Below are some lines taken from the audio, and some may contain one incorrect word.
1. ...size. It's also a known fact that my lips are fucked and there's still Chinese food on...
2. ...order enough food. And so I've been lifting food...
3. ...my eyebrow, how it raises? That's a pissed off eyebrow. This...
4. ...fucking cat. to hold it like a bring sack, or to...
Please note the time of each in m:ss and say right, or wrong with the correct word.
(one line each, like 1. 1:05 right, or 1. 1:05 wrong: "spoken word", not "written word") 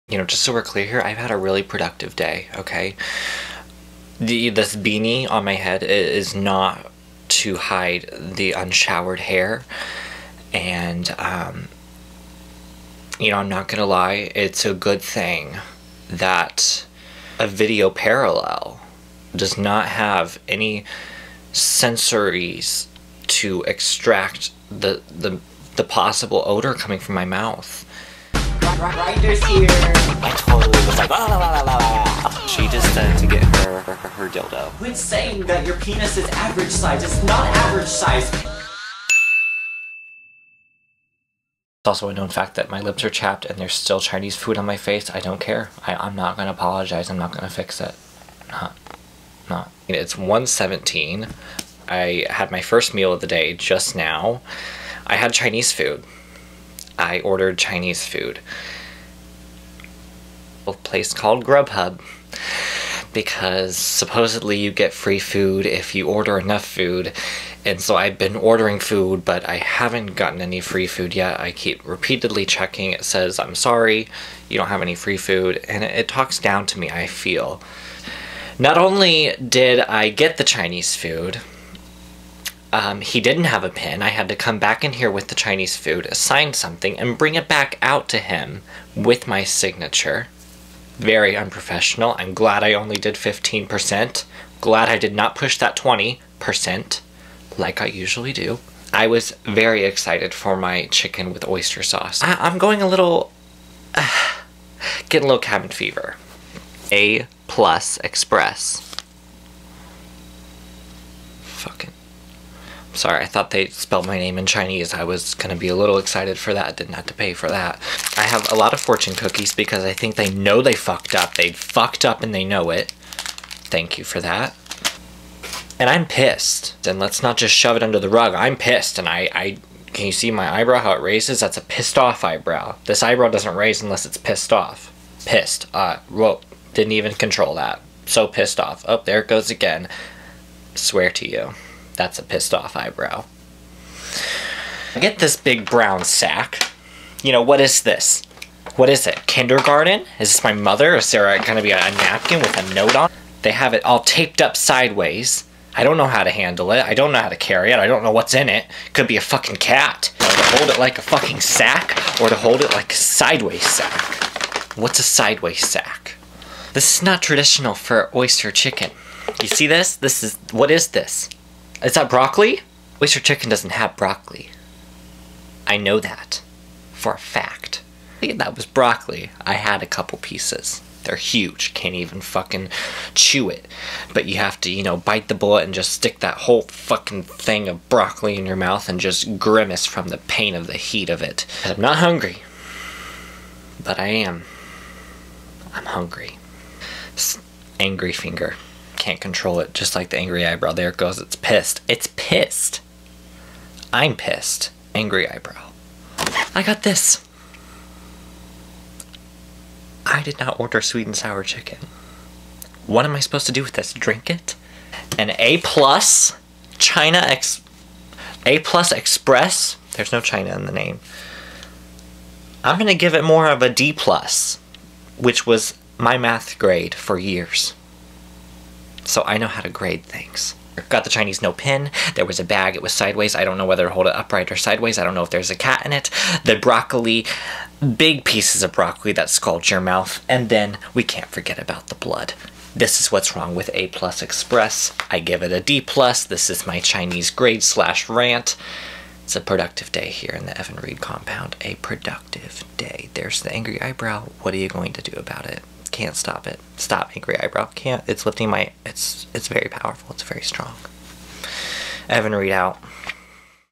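1. 0:37 wrong: "chapped", not "fucked"
2. 1:06 wrong: "ordering", not "lifting"
3. 2:10 right
4. 2:39 wrong: "fucking", not "bring".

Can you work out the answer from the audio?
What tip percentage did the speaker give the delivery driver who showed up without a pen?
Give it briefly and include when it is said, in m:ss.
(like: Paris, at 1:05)
15%, at 1:33.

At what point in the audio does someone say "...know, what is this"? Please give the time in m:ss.
2:27.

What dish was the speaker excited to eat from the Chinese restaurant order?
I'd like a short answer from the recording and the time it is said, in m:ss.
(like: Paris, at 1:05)
chicken with oyster sauce, at 1:40.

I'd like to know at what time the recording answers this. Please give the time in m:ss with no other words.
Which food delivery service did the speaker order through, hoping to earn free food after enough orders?
1:01.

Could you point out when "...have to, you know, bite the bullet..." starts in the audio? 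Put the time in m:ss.
3:04.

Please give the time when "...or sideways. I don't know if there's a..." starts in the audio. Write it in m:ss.
3:54.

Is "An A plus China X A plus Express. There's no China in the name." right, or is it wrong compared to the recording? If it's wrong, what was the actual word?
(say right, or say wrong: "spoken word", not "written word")
right.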